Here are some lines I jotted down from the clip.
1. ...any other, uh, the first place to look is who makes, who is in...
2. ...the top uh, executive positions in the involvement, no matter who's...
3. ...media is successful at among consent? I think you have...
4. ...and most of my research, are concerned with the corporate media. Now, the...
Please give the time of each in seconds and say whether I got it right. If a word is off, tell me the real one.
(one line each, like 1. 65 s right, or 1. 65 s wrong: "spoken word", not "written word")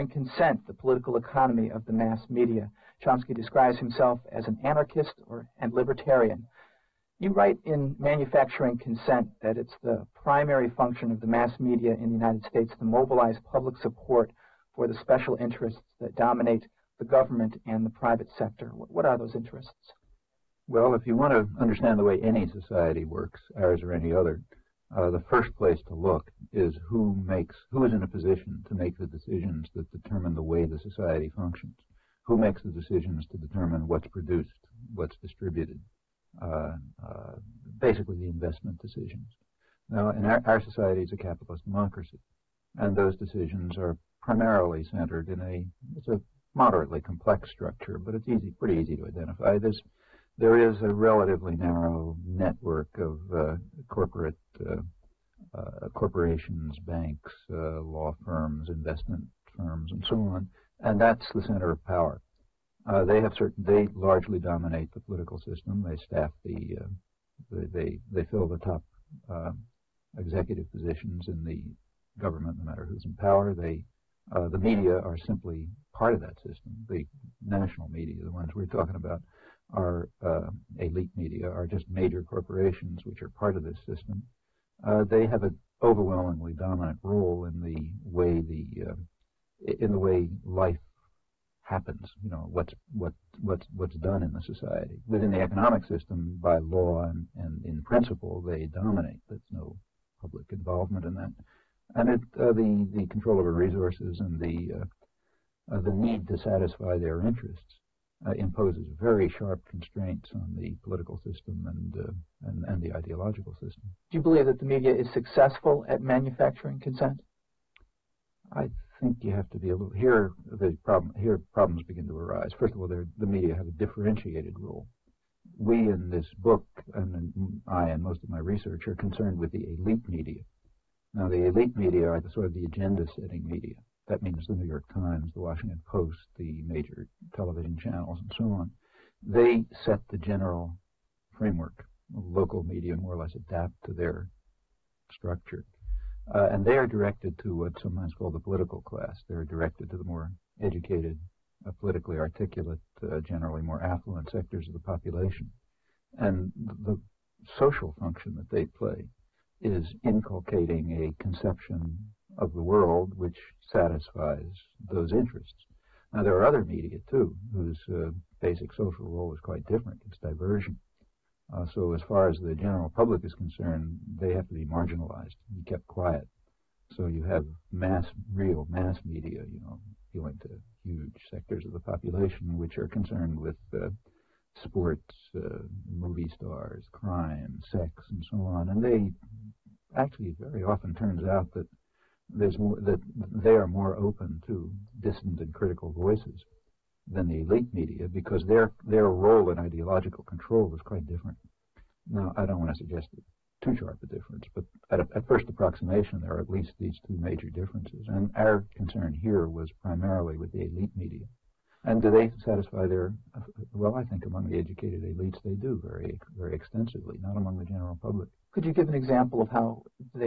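1. 23 s right
2. 68 s wrong: "government", not "involvement"
3. 114 s wrong: "manufacturing", not "among"
4. 127 s wrong: "elite", not "corporate".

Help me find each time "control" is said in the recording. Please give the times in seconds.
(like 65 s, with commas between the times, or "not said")
103 s, 200 s.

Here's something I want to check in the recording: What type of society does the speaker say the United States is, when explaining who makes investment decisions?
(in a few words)
capitalist democracy.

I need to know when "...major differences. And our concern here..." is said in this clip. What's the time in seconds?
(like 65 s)
207 s.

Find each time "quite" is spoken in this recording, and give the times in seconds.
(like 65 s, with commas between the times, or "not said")
169 s, 200 s.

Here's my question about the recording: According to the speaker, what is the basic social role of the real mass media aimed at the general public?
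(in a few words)
diversion.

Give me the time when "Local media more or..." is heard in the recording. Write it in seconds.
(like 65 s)
142 s.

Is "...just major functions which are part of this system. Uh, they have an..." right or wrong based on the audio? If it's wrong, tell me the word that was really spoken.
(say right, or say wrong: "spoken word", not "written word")
wrong: "corporations", not "functions".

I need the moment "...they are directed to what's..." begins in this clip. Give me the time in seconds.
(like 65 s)
146 s.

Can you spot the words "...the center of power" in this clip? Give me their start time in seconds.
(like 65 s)
61 s.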